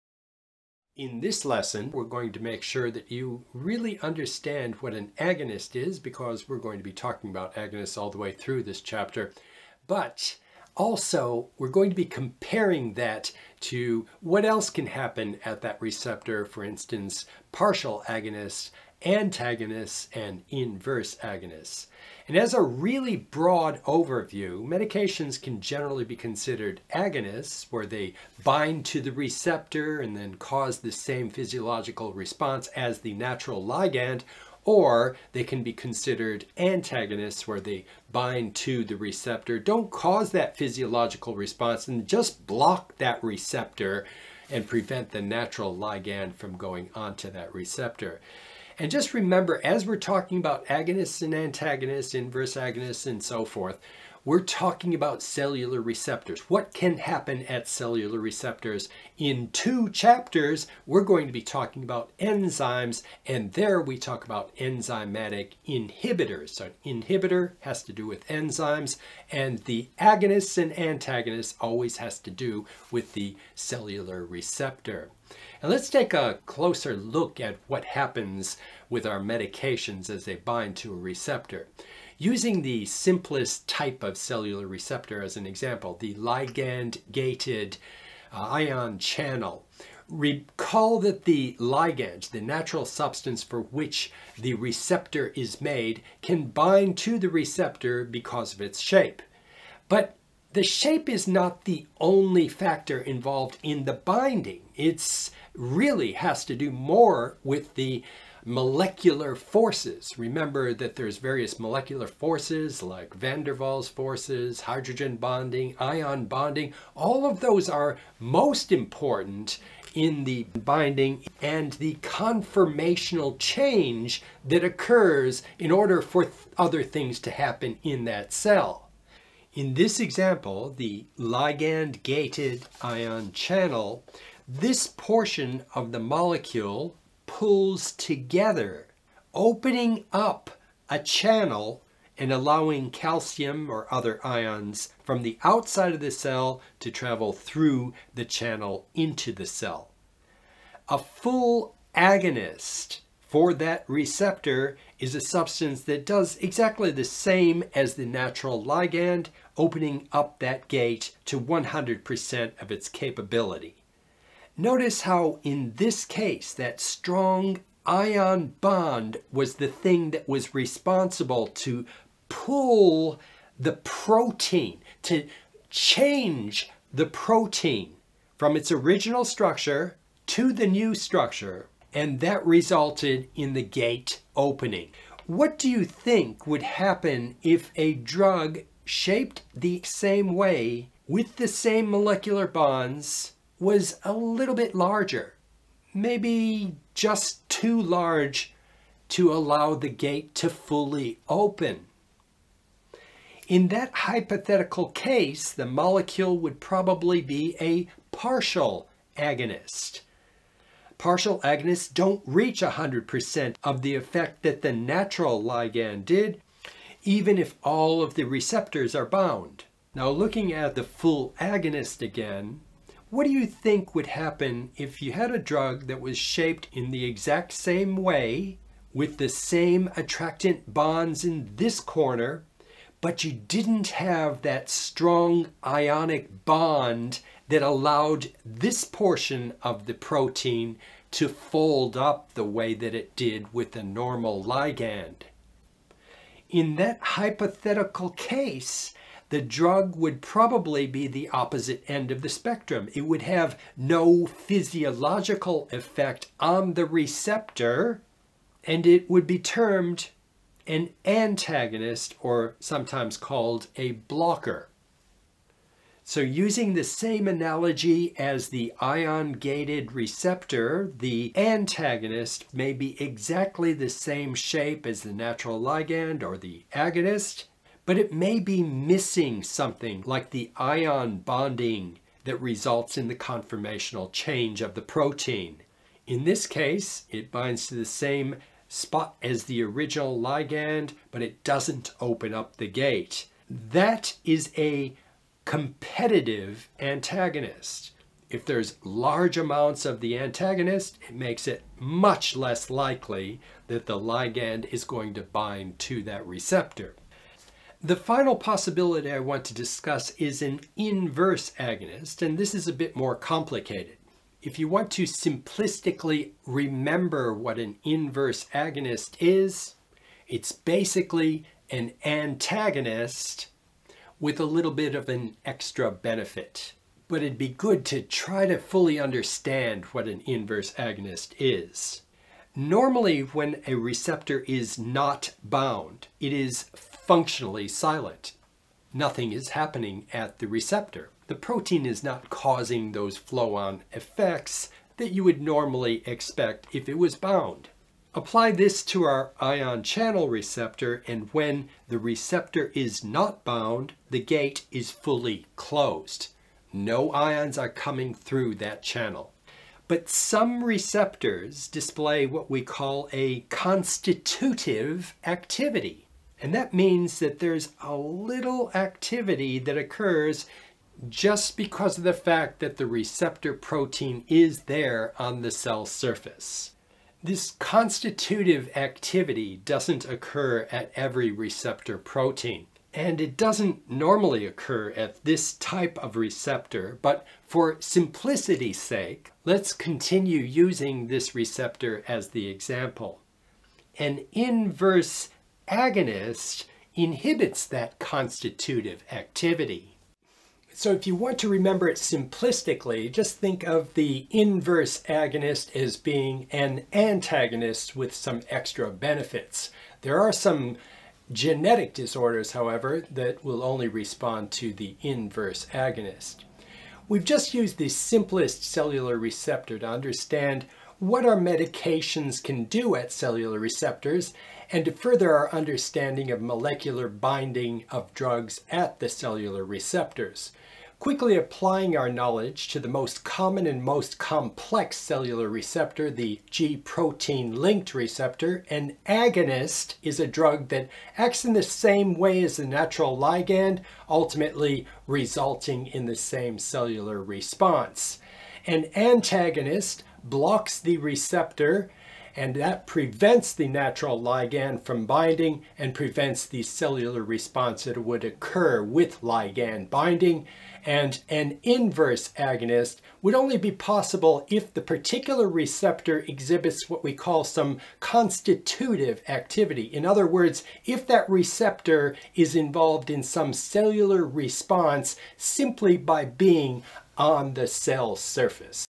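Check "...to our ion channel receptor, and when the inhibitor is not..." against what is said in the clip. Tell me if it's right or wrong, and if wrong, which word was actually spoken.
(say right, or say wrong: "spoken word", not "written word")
wrong: "receptor", not "inhibitor".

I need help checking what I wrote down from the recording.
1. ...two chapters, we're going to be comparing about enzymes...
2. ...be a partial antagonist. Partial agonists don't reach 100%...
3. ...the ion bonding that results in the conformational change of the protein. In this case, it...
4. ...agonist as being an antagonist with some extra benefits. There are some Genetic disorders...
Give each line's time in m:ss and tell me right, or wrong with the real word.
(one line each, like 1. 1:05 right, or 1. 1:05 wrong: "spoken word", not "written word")
1. 0:59 wrong: "talking", not "comparing"
2. 3:27 wrong: "agonist", not "antagonist"
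3. 4:40 right
4. 6:45 right.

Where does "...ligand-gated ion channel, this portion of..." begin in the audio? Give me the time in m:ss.
2:11.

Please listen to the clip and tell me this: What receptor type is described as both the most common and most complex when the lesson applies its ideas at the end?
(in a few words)
G protein linked receptor.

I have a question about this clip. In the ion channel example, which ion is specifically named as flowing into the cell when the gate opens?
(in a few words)
Calcium.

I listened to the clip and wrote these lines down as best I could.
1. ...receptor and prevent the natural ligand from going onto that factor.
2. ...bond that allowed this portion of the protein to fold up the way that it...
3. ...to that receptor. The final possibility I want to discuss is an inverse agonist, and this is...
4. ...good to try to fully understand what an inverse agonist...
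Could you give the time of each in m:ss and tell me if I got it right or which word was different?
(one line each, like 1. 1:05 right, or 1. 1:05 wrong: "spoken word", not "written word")
1. 0:43 wrong: "receptor", not "factor"
2. 3:56 right
3. 5:05 right
4. 5:27 right.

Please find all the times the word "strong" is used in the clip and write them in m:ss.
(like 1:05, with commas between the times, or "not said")
2:46, 3:54.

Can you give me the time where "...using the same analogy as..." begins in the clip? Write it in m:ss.
4:26.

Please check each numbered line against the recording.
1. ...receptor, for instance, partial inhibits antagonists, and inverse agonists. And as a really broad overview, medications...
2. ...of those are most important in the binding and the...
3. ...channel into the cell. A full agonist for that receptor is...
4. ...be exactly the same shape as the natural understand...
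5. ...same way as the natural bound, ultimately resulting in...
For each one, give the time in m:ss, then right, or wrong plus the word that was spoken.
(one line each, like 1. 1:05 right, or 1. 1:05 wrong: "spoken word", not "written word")
1. 0:15 wrong: "agonists", not "inhibits"
2. 1:57 right
3. 2:28 right
4. 4:32 wrong: "ligand", not "understand"
5. 7:21 wrong: "ligand", not "bound".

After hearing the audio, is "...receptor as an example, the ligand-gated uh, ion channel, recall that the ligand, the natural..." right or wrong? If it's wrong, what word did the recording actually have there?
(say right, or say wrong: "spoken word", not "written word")
right.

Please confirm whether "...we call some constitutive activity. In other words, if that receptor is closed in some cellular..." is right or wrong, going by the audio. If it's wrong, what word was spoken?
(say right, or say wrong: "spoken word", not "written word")
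wrong: "involved", not "closed".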